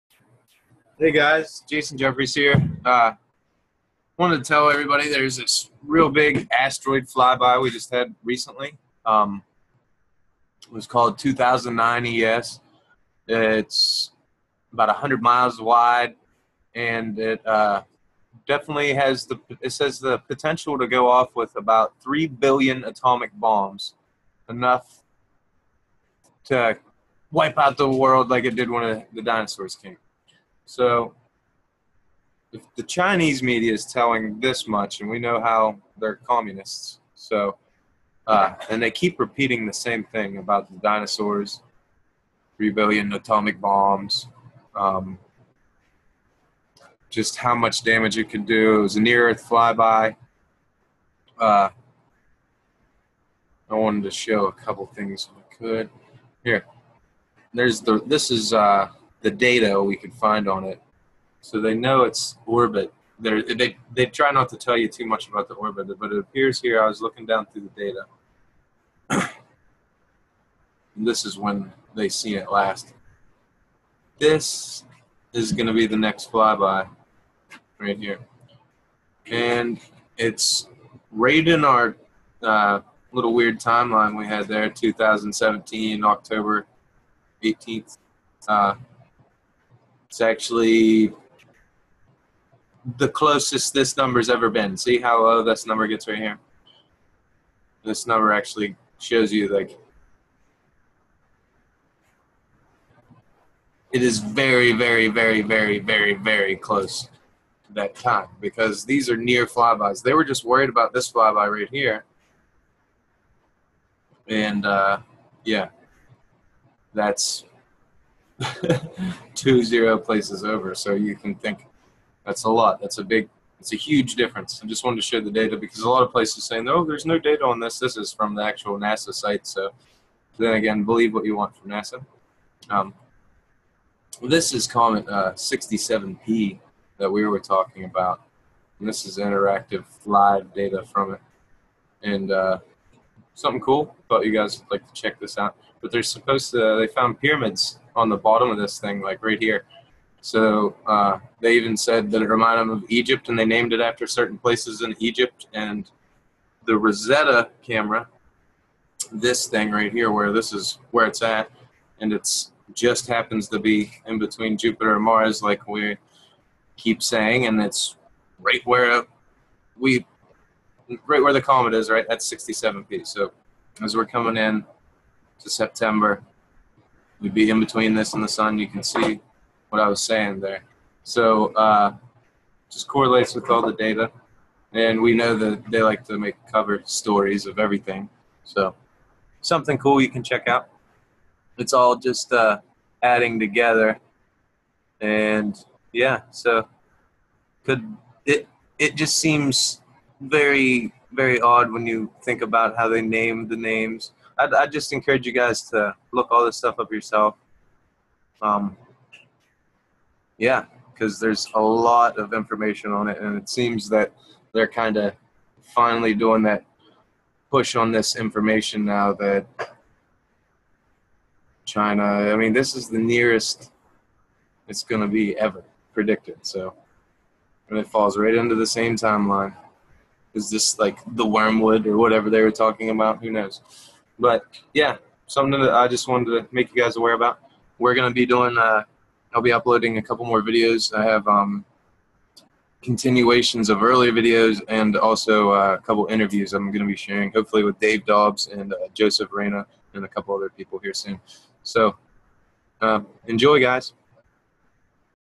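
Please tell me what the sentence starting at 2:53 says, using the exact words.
So as we're coming in to September, we'd be in between this and the sun.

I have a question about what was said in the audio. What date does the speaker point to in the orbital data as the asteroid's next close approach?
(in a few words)
October 18th, 2017.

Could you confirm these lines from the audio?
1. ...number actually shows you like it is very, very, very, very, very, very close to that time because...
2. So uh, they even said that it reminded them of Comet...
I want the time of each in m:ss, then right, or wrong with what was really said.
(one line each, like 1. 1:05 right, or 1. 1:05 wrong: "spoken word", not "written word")
1. 1:38 right
2. 2:30 wrong: "Egypt", not "Comet".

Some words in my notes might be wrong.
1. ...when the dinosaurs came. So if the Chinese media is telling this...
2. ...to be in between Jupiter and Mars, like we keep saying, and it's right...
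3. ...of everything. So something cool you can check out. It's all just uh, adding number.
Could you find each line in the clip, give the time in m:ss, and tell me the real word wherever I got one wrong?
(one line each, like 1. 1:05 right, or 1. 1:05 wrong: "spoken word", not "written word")
1. 0:28 right
2. 2:43 right
3. 3:07 wrong: "together", not "number".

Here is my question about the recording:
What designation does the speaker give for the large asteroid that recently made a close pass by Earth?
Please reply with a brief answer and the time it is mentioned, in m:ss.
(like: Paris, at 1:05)
2009 ES, at 0:11.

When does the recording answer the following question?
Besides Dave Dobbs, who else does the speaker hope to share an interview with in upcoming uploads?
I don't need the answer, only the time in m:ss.
4:08.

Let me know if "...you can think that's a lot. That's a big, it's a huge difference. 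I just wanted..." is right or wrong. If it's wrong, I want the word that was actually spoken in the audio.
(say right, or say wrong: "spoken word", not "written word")
right.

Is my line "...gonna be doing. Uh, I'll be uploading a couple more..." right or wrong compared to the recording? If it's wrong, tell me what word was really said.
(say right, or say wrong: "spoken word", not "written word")
right.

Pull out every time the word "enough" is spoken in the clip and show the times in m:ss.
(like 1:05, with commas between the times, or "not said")
0:24.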